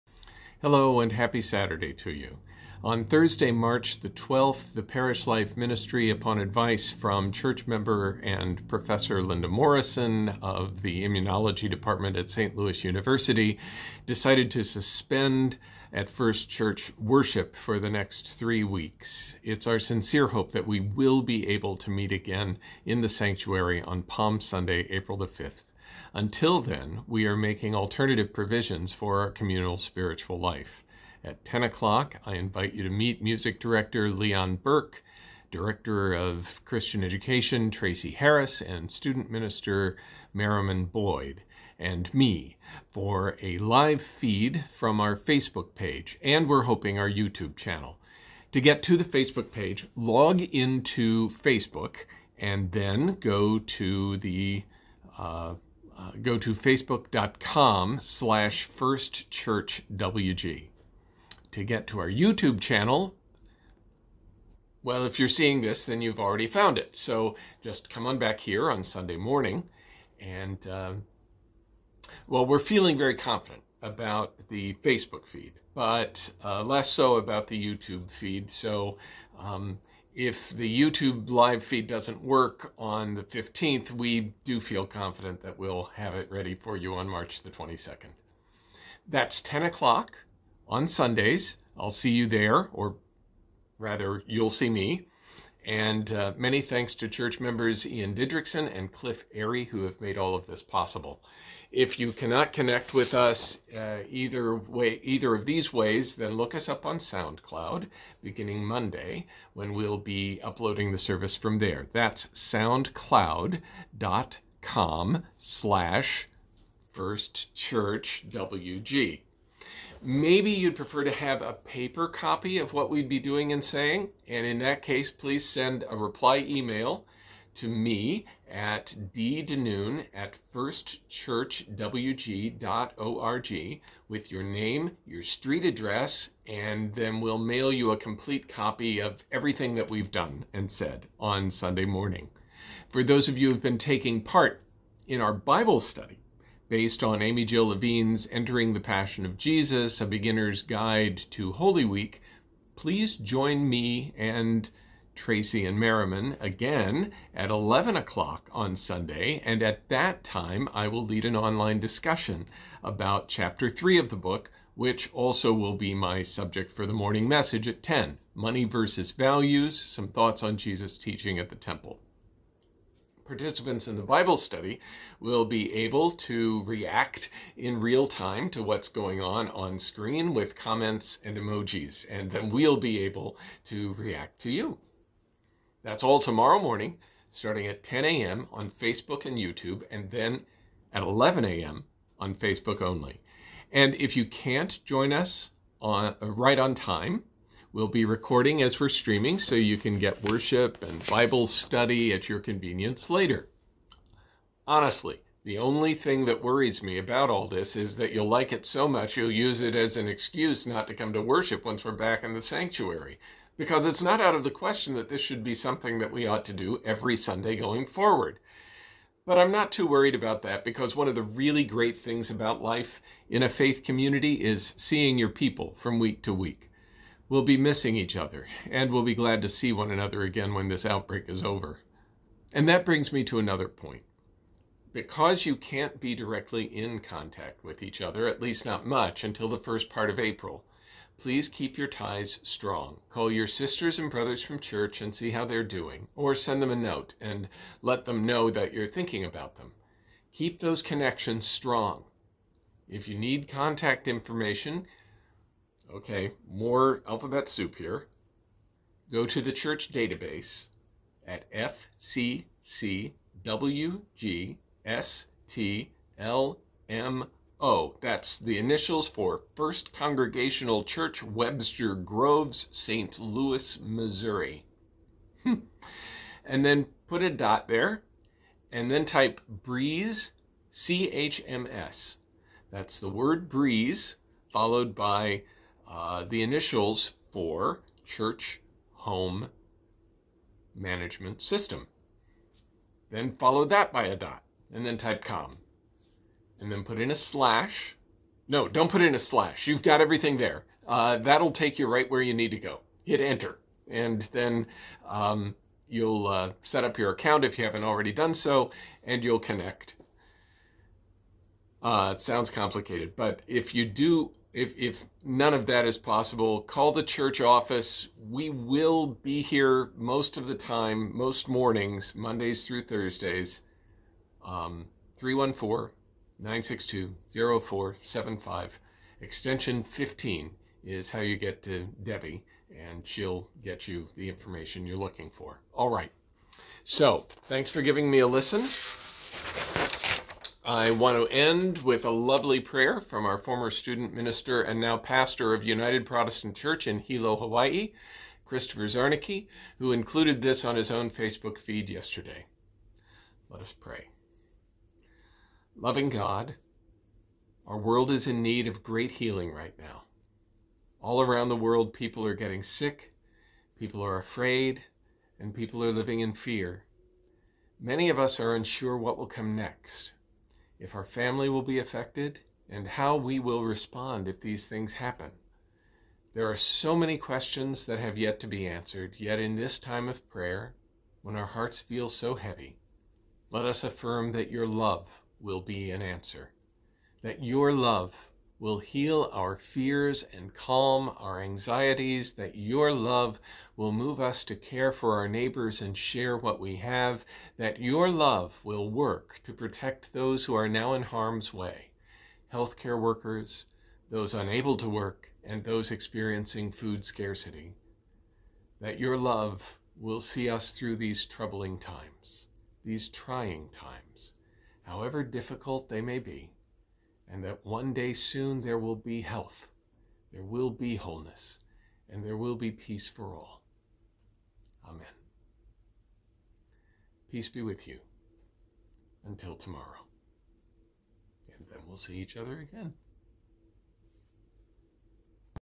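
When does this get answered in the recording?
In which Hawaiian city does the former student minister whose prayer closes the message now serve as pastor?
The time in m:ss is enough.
5:46.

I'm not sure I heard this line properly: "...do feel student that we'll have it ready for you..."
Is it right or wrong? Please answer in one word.
wrong.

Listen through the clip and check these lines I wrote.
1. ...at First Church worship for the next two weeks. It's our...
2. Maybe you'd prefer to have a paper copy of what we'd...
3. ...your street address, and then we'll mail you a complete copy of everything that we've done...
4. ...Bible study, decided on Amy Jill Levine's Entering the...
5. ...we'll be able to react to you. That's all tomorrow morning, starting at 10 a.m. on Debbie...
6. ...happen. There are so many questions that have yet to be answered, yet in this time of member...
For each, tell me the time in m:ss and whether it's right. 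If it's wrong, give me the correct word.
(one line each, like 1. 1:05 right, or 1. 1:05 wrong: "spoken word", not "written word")
1. 0:15 wrong: "three", not "two"
2. 2:00 right
3. 2:15 right
4. 2:25 wrong: "based", not "decided"
5. 3:02 wrong: "Facebook", not "Debbie"
6. 6:14 wrong: "prayer", not "member".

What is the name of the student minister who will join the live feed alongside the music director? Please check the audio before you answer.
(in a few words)
Merrimon Boyd.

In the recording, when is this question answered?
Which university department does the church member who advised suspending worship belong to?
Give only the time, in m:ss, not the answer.
0:11.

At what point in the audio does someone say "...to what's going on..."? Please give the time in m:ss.
2:58.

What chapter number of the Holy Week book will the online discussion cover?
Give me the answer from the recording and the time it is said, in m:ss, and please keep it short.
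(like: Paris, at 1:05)
3, at 2:43.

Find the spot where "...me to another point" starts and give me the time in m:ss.
3:53.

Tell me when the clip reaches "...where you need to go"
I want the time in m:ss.
5:02.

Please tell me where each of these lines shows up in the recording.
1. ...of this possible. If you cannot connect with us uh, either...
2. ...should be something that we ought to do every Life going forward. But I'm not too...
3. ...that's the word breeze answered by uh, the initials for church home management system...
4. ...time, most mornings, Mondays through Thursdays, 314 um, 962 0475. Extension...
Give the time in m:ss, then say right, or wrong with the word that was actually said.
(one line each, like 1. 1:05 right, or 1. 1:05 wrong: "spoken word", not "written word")
1. 1:40 right
2. 3:35 wrong: "Sunday", not "Life"
3. 4:42 wrong: "followed", not "answered"
4. 5:20 right.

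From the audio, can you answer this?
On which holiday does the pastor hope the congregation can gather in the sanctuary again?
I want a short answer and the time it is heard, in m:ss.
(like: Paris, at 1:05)
Palm Sunday, at 0:24.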